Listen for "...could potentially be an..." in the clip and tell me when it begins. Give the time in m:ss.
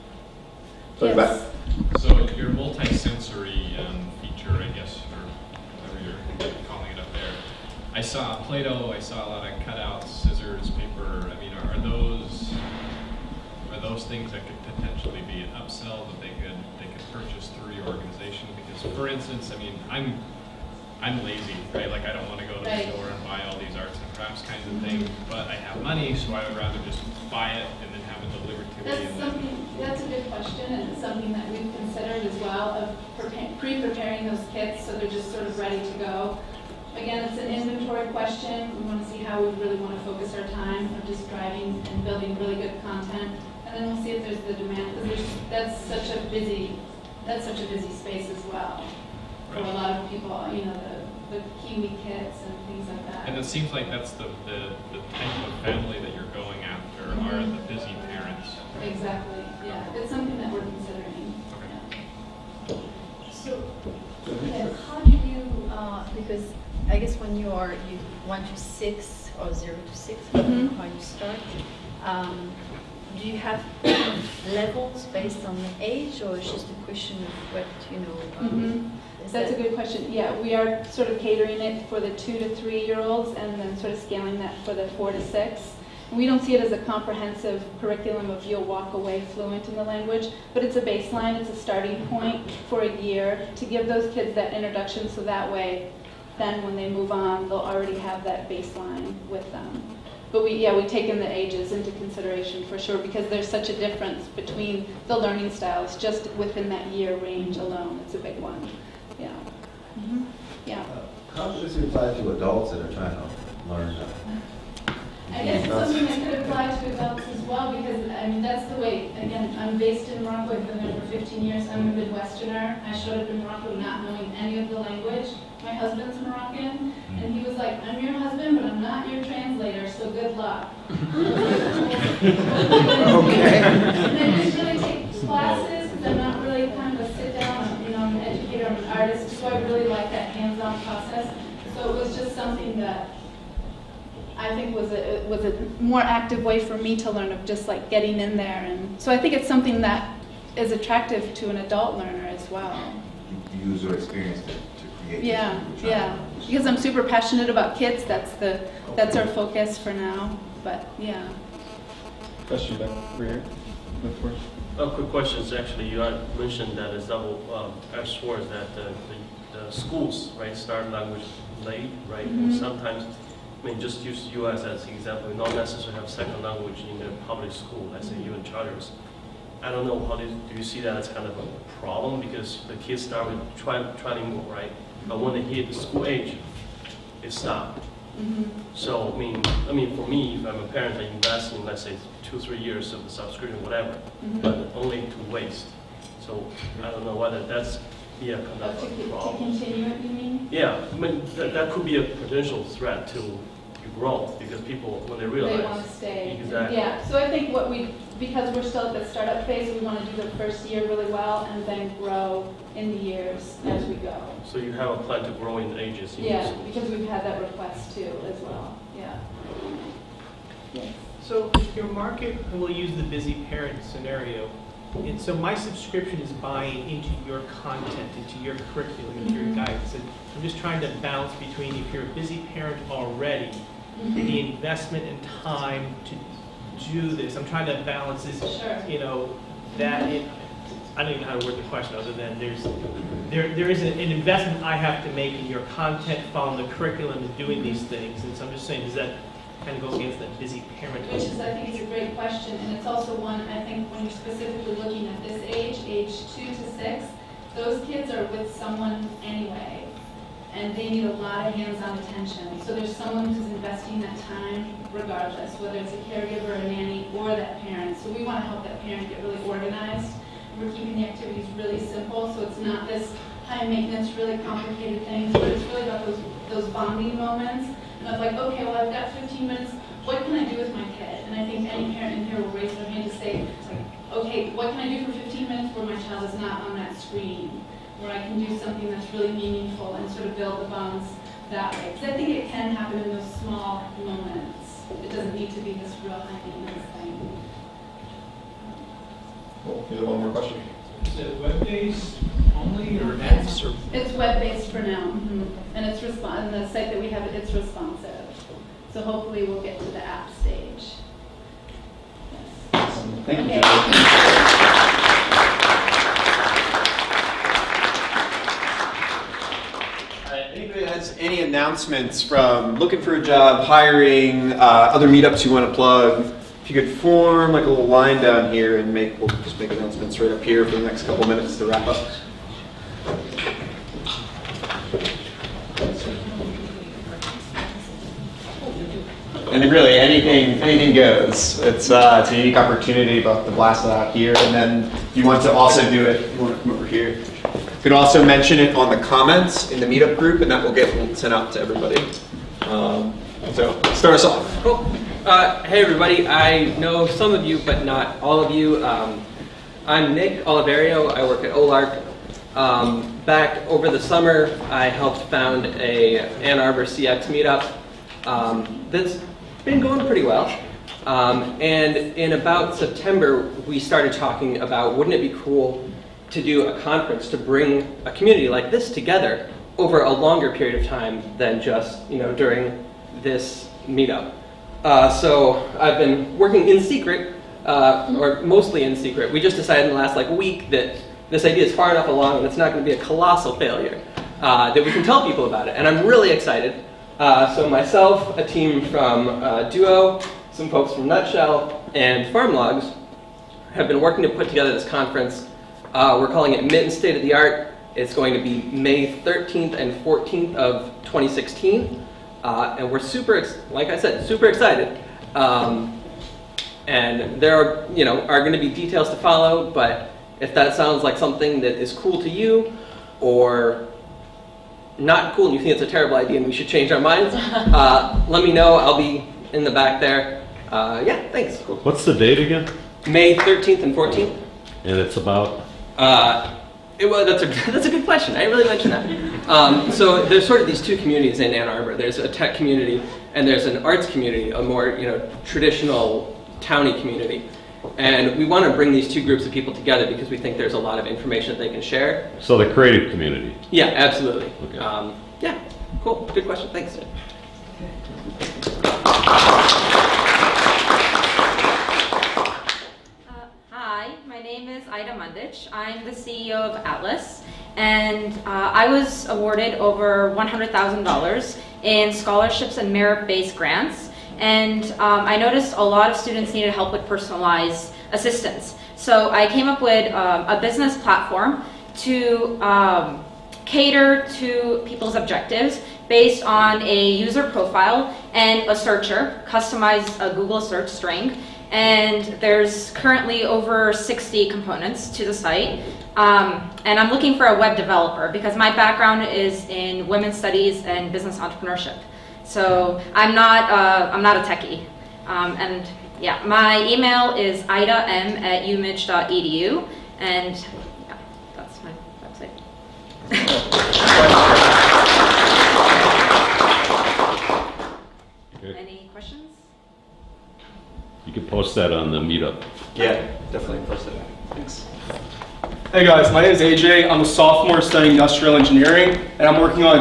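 0:14.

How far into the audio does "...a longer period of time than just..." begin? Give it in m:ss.
6:20.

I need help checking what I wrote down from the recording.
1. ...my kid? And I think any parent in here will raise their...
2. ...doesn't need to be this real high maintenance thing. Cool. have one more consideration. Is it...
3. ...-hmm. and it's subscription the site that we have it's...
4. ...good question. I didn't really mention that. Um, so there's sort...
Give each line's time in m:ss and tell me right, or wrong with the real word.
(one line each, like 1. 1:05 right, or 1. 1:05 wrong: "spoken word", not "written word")
1. 4:40 right
2. 4:55 wrong: "question", not "consideration"
3. 5:05 wrong: "respon", not "subscription"
4. 7:17 right.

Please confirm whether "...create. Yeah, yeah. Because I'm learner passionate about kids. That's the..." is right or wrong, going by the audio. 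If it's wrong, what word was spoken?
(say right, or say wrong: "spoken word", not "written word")
wrong: "super", not "learner".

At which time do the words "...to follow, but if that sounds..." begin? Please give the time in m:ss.
6:59.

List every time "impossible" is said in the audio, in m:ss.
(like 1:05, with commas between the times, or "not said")
not said.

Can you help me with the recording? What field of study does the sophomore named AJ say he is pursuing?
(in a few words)
Industrial engineering.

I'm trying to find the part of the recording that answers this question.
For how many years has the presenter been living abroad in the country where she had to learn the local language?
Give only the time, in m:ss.
2:01.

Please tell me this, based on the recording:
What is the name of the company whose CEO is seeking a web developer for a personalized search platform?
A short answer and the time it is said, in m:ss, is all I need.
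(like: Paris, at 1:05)
Atlas, at 7:46.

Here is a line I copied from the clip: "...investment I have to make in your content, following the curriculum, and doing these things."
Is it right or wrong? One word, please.
right.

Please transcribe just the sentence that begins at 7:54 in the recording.
And um, I noticed a lot of students needed help with personalized assistance.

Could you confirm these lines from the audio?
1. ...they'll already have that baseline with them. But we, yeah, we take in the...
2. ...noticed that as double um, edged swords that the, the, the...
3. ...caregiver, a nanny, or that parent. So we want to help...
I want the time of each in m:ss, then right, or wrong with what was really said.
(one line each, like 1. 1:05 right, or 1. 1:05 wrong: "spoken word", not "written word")
1. 1:37 right
2. 2:46 wrong: "mentioned", not "noticed"
3. 4:26 right.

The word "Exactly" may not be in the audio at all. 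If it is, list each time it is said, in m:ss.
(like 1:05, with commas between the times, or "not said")
0:58, 3:26.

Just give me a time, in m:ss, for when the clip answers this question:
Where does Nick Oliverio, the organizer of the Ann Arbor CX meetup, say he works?
6:01.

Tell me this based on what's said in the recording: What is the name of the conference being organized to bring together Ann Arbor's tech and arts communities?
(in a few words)
Mitten State of the Art.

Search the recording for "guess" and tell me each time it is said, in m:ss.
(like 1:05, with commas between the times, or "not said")
0:04, 1:06, 1:55.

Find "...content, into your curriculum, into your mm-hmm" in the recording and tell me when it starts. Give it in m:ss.
3:47.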